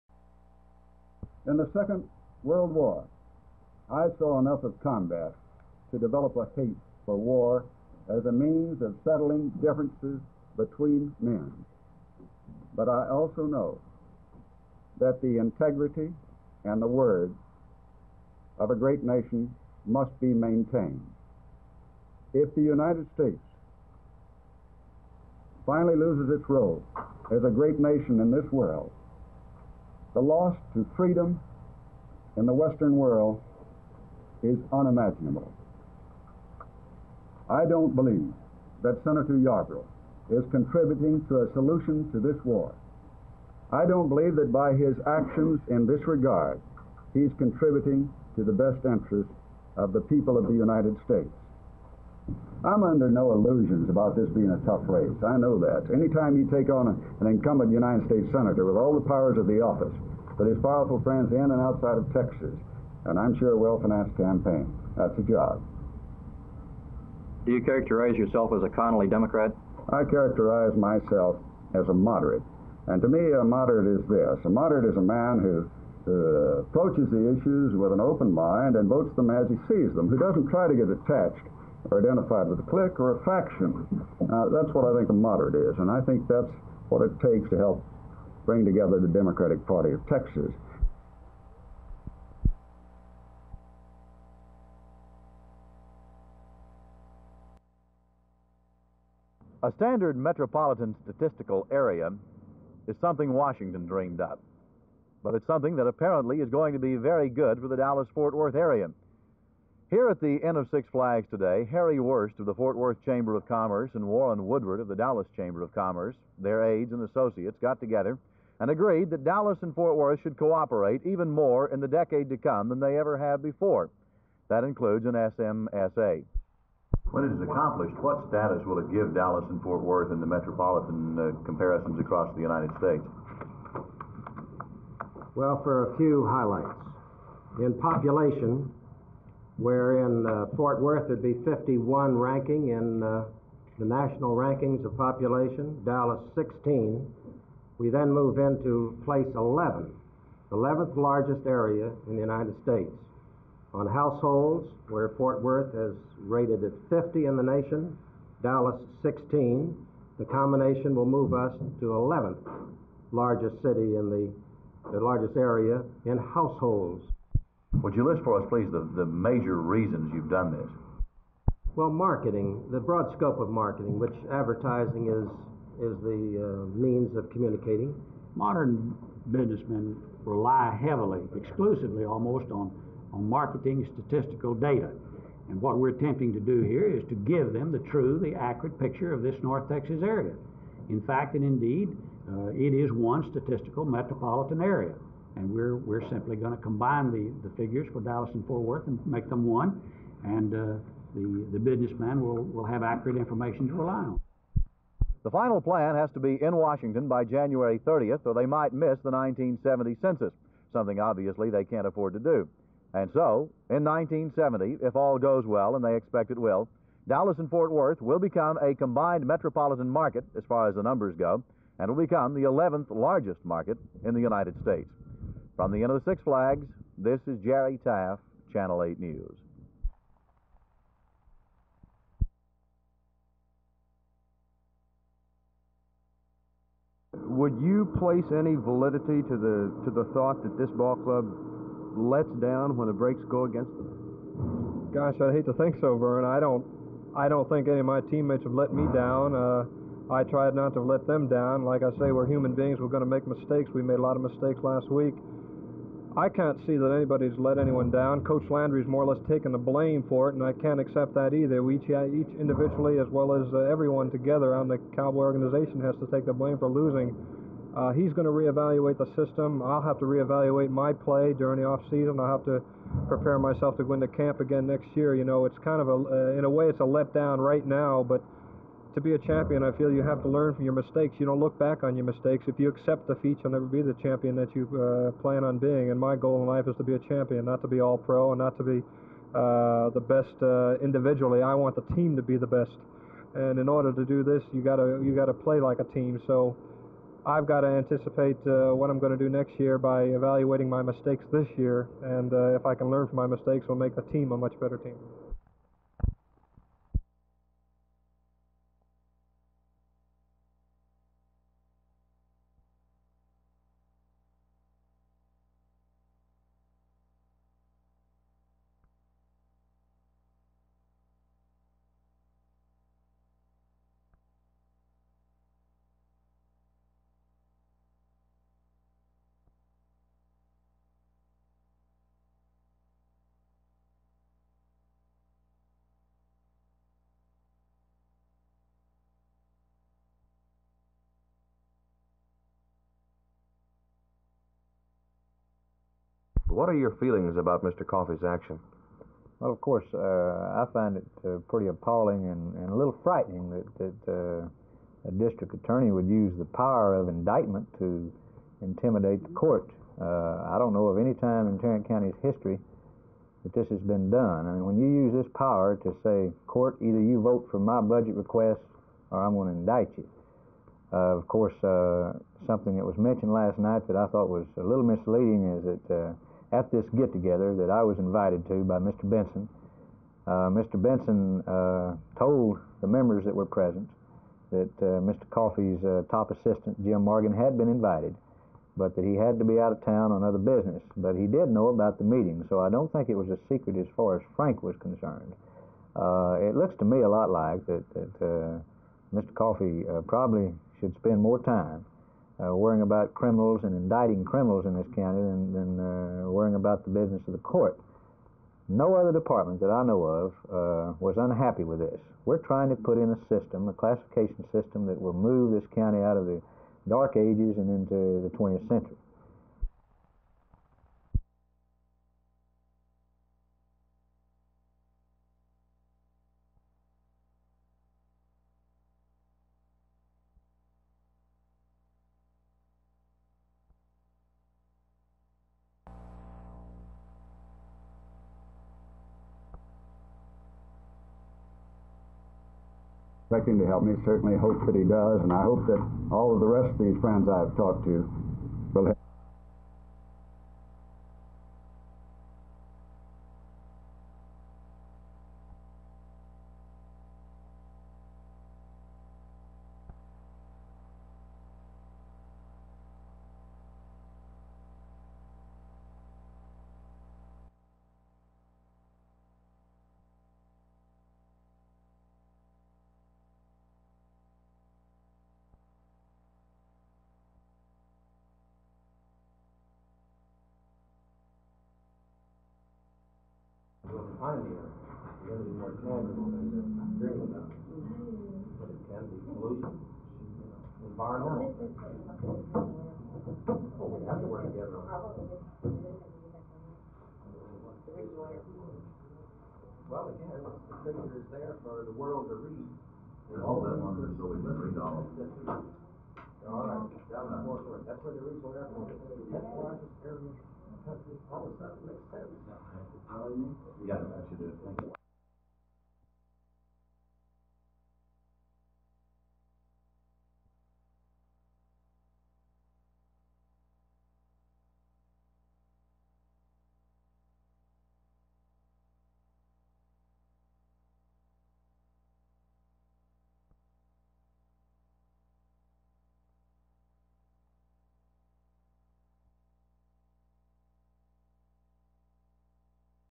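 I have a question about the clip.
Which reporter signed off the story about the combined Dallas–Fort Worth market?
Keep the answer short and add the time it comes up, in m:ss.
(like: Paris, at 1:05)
Jerry Taff, at 3:47.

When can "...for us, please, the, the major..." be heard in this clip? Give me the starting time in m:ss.
2:48.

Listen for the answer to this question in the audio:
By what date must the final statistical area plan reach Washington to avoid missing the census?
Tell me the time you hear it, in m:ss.
3:27.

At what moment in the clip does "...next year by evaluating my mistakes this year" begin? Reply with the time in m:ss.
4:59.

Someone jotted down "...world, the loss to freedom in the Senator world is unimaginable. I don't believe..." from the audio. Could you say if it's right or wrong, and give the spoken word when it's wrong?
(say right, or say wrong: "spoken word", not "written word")
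wrong: "Western", not "Senator".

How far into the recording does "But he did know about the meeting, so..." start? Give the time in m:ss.
6:30.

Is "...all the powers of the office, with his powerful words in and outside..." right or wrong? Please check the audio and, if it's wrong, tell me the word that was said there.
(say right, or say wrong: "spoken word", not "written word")
wrong: "friends", not "words".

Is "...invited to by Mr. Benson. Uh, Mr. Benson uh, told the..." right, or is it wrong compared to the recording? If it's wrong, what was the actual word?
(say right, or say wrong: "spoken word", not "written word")
right.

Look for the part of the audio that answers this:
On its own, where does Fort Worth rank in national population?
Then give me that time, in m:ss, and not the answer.
2:21.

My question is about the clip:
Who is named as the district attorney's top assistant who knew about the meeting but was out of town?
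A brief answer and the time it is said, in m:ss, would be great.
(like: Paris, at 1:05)
Jim Morgan, at 6:26.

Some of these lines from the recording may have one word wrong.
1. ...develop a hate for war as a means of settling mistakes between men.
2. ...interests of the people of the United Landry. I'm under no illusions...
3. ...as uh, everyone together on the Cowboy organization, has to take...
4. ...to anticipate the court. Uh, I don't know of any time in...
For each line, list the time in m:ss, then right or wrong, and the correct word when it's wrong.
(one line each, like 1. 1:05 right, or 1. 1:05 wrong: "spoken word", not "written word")
1. 0:05 wrong: "differences", not "mistakes"
2. 0:48 wrong: "States", not "Landry"
3. 4:23 right
4. 5:57 wrong: "intimidate", not "anticipate".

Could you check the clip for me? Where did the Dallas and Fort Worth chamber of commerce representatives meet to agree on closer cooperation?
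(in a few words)
Inn of Six Flags.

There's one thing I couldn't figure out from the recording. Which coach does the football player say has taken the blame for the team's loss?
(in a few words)
Coach Landry.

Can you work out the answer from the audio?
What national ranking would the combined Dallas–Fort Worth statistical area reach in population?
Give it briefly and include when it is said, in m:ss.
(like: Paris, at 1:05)
11th, at 2:30.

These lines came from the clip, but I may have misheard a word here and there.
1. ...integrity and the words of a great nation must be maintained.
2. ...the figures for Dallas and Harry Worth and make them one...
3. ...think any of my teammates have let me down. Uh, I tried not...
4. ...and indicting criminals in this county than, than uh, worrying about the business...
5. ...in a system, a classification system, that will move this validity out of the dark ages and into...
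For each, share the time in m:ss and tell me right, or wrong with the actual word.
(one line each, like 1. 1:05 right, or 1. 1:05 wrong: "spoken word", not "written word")
1. 0:15 right
2. 3:17 wrong: "Fort", not "Harry"
3. 4:07 right
4. 6:43 right
5. 6:52 wrong: "county", not "validity".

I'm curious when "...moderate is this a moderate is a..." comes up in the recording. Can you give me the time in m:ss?
1:13.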